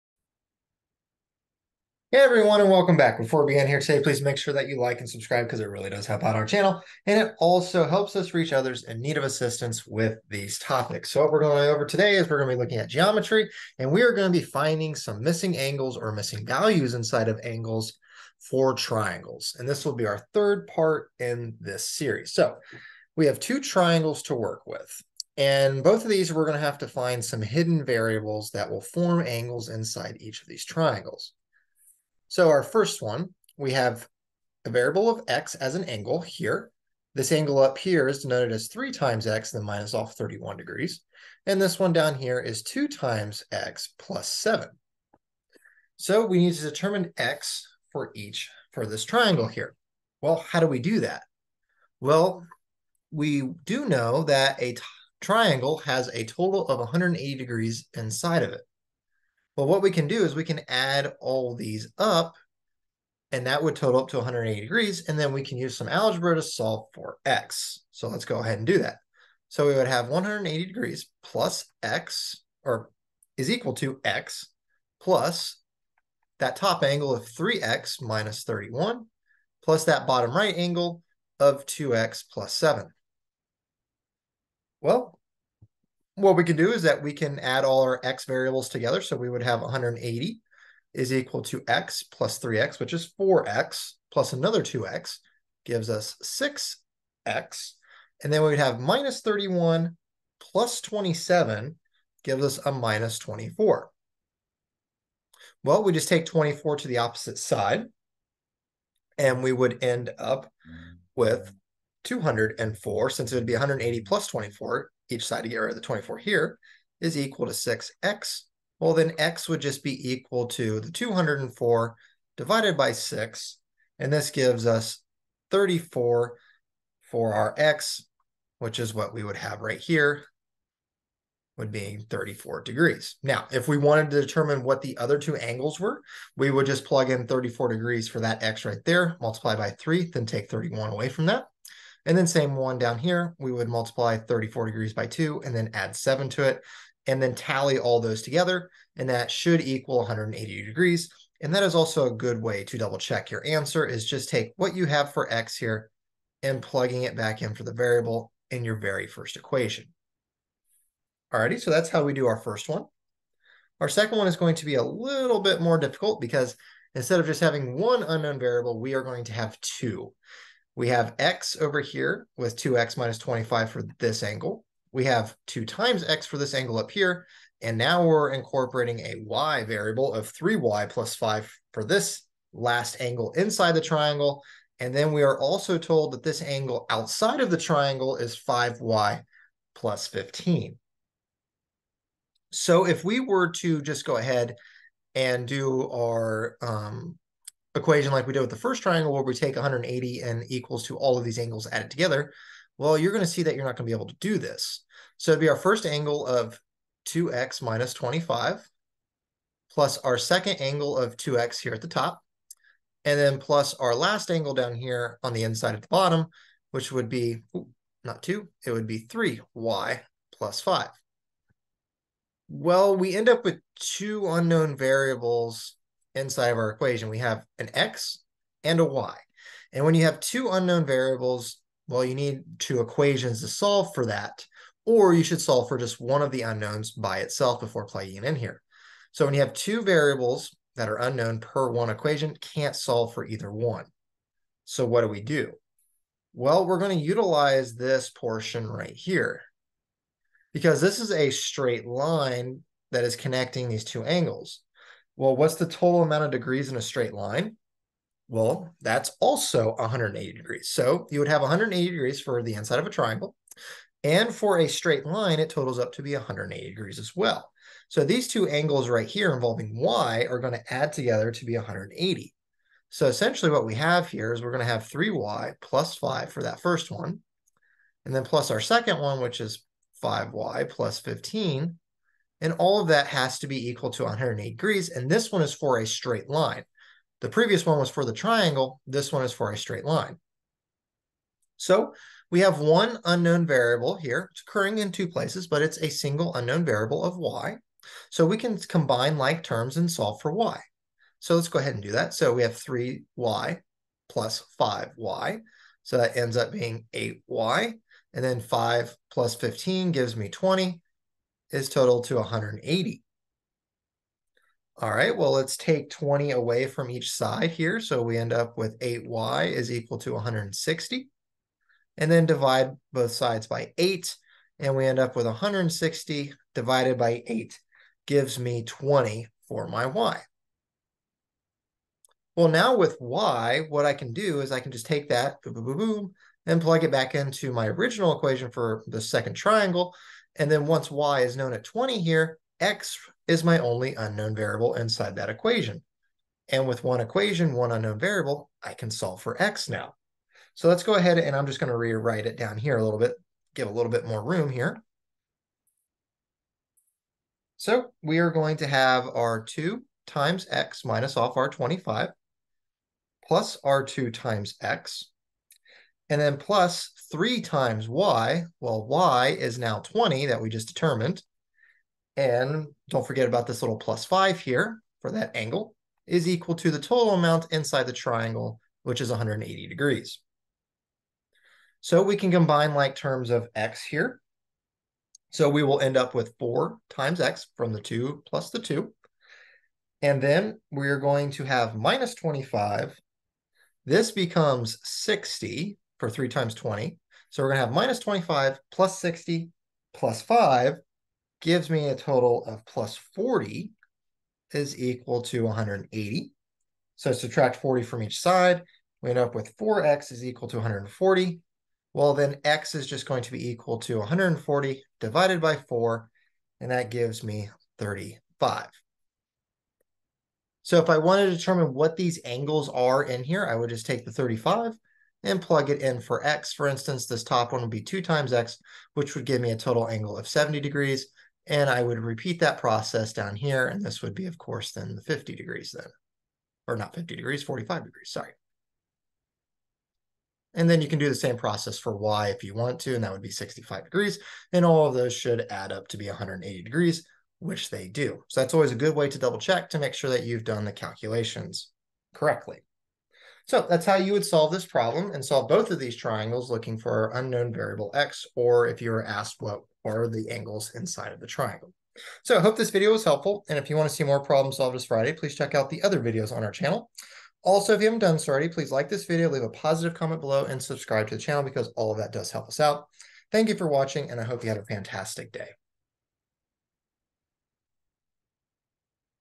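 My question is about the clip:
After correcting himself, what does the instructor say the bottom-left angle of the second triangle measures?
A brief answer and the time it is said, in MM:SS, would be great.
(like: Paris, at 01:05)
45 degrees, at 07:17.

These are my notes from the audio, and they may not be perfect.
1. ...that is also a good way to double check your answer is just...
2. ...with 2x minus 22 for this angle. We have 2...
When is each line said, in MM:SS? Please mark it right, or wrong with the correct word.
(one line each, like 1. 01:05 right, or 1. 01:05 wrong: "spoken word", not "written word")
1. 02:31 right
2. 02:52 wrong: "25", not "22".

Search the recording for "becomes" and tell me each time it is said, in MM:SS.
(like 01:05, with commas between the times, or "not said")
06:34.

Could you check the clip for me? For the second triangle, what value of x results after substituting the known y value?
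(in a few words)
35.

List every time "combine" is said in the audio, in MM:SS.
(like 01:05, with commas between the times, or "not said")
04:58, 06:22.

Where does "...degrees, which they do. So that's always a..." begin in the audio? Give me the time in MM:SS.
07:26.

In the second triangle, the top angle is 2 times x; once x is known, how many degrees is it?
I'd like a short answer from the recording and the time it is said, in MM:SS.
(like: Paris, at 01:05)
70 degrees, at 07:10.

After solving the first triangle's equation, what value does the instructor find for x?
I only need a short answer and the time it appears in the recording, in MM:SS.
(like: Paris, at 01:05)
34, at 02:04.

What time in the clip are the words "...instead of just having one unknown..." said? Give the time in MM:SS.
02:46.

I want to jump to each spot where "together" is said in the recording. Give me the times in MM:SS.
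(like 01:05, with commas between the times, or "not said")
01:28, 02:28, 03:21, 04:30.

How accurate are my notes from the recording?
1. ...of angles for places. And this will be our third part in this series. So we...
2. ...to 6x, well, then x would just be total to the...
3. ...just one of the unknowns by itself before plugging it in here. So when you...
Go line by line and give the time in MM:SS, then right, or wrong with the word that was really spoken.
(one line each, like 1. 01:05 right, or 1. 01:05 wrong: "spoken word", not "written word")
1. 00:17 wrong: "triangles", not "places"
2. 01:57 wrong: "equal", not "total"
3. 03:55 right.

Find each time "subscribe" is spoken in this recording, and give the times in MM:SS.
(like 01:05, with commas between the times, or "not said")
00:05, 07:50.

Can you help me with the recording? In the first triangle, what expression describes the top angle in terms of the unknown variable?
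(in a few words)
3x - 31.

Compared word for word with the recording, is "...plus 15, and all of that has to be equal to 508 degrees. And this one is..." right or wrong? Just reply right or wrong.
wrong.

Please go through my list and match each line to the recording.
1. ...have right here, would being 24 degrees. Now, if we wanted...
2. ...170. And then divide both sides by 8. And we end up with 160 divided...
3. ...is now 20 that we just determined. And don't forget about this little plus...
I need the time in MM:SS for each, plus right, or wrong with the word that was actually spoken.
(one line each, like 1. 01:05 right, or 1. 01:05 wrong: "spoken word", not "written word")
1. 02:09 wrong: "34", not "24"
2. 05:20 wrong: "160", not "170"
3. 06:09 right.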